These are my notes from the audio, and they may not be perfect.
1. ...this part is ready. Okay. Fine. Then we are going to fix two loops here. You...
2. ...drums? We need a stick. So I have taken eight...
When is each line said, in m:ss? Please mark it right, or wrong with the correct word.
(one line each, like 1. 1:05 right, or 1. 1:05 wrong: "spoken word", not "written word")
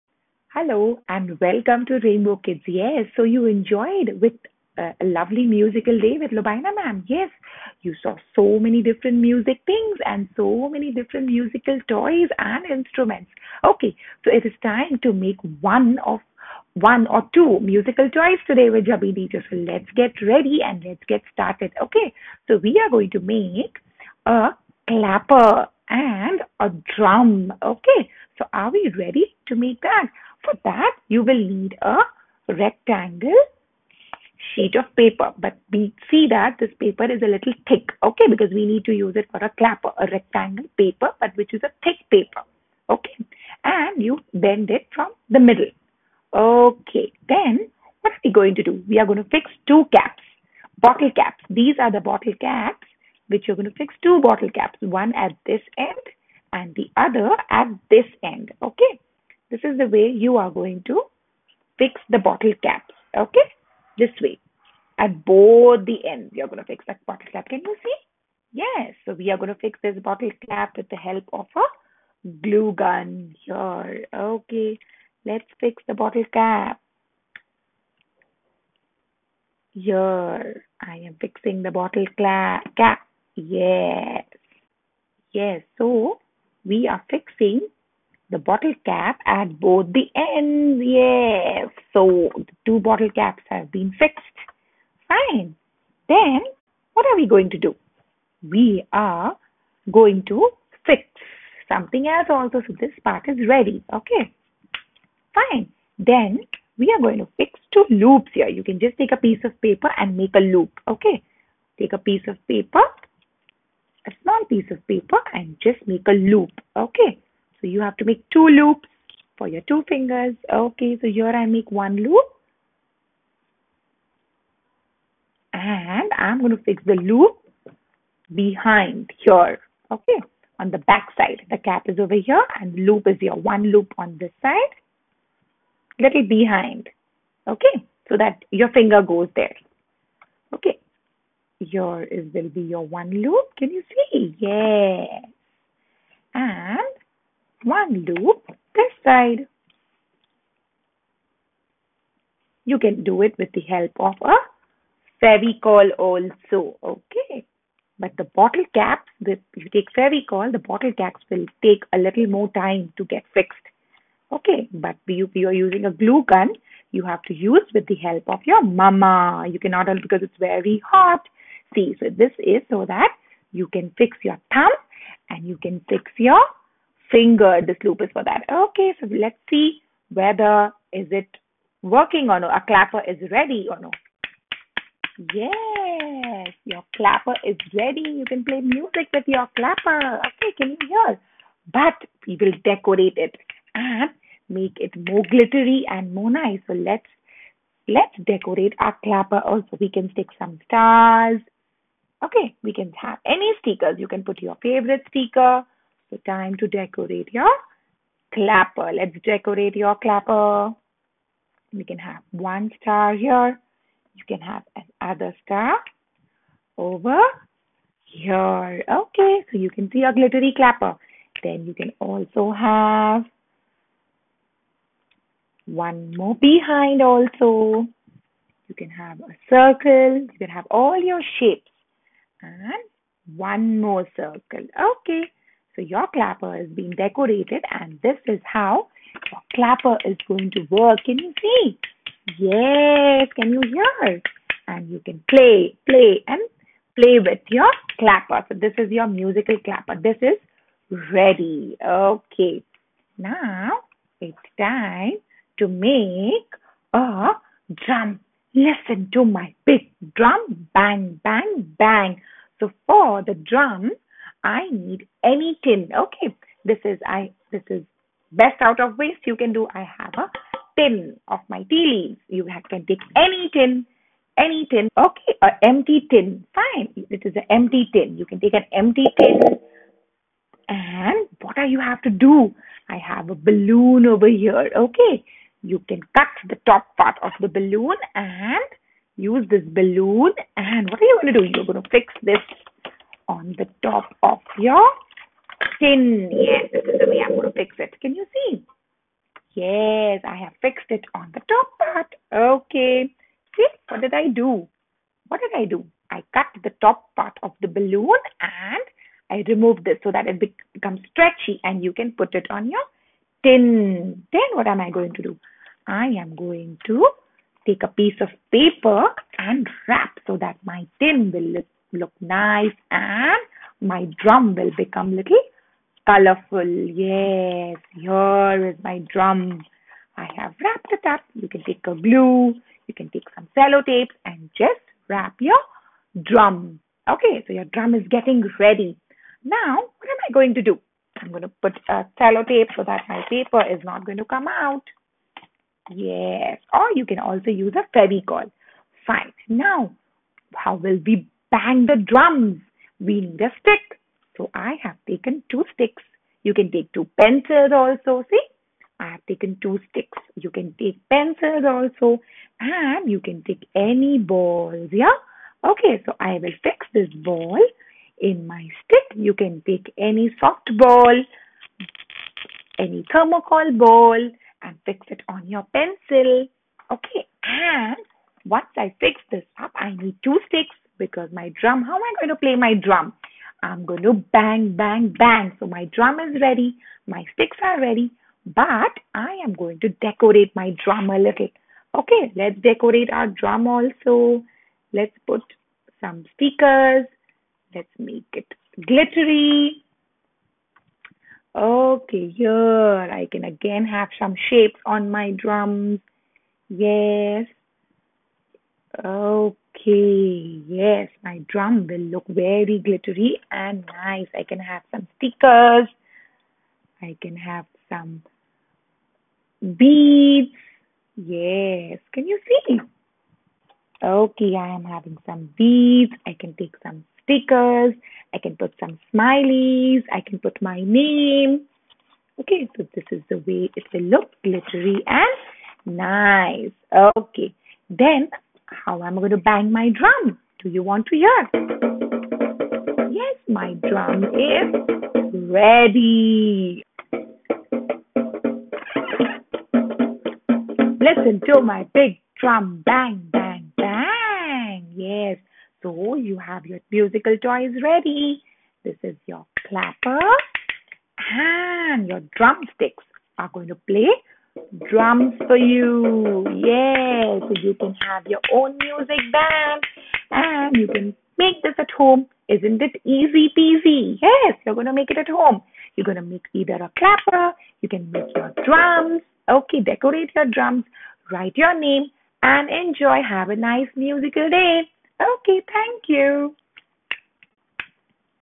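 1. 1:42 right
2. 5:52 wrong: "two", not "eight".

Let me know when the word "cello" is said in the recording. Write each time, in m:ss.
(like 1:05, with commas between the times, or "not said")
5:33, 5:42.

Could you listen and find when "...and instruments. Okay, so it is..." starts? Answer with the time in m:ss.
0:12.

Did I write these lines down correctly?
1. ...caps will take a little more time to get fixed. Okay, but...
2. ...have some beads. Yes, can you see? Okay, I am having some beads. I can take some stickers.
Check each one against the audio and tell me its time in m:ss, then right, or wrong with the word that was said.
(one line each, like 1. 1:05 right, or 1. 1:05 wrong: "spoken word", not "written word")
1. 2:40 right
2. 6:57 right.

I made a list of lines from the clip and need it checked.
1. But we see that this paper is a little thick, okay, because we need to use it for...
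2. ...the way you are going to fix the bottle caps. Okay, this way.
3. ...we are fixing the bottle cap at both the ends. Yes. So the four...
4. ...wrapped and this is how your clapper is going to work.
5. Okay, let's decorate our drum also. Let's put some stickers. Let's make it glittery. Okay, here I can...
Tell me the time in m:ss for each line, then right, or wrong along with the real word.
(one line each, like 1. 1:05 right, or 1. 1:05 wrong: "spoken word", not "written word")
1. 0:35 right
2. 0:59 right
3. 1:26 wrong: "two", not "four"
4. 3:56 wrong: "decorated", not "wrapped"
5. 6:31 right.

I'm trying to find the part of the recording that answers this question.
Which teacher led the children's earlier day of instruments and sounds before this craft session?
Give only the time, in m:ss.
0:06.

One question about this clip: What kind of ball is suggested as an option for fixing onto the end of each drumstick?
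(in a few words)
Thermocol ball.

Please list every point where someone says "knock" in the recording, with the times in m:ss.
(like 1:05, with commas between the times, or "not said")
not said.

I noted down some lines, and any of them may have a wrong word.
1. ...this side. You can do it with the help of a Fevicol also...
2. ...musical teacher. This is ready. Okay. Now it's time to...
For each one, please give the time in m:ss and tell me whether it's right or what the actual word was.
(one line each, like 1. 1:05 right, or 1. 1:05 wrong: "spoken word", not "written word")
1. 2:28 right
2. 4:09 wrong: "clapper", not "teacher".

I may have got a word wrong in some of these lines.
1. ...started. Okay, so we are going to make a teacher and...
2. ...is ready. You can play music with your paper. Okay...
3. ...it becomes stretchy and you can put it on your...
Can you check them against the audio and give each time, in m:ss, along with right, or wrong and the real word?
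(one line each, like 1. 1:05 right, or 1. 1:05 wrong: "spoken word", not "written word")
1. 0:21 wrong: "clapper", not "teacher"
2. 3:07 wrong: "clapper", not "paper"
3. 5:10 right.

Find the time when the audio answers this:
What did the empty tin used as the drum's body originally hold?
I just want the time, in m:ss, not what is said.
4:31.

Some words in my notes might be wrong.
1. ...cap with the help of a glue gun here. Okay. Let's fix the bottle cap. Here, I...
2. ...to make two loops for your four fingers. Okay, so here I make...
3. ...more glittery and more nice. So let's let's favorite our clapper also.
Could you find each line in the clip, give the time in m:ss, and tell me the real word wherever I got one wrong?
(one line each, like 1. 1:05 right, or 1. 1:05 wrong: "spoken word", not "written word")
1. 1:10 right
2. 1:57 wrong: "two", not "four"
3. 3:15 wrong: "decorate", not "favorite".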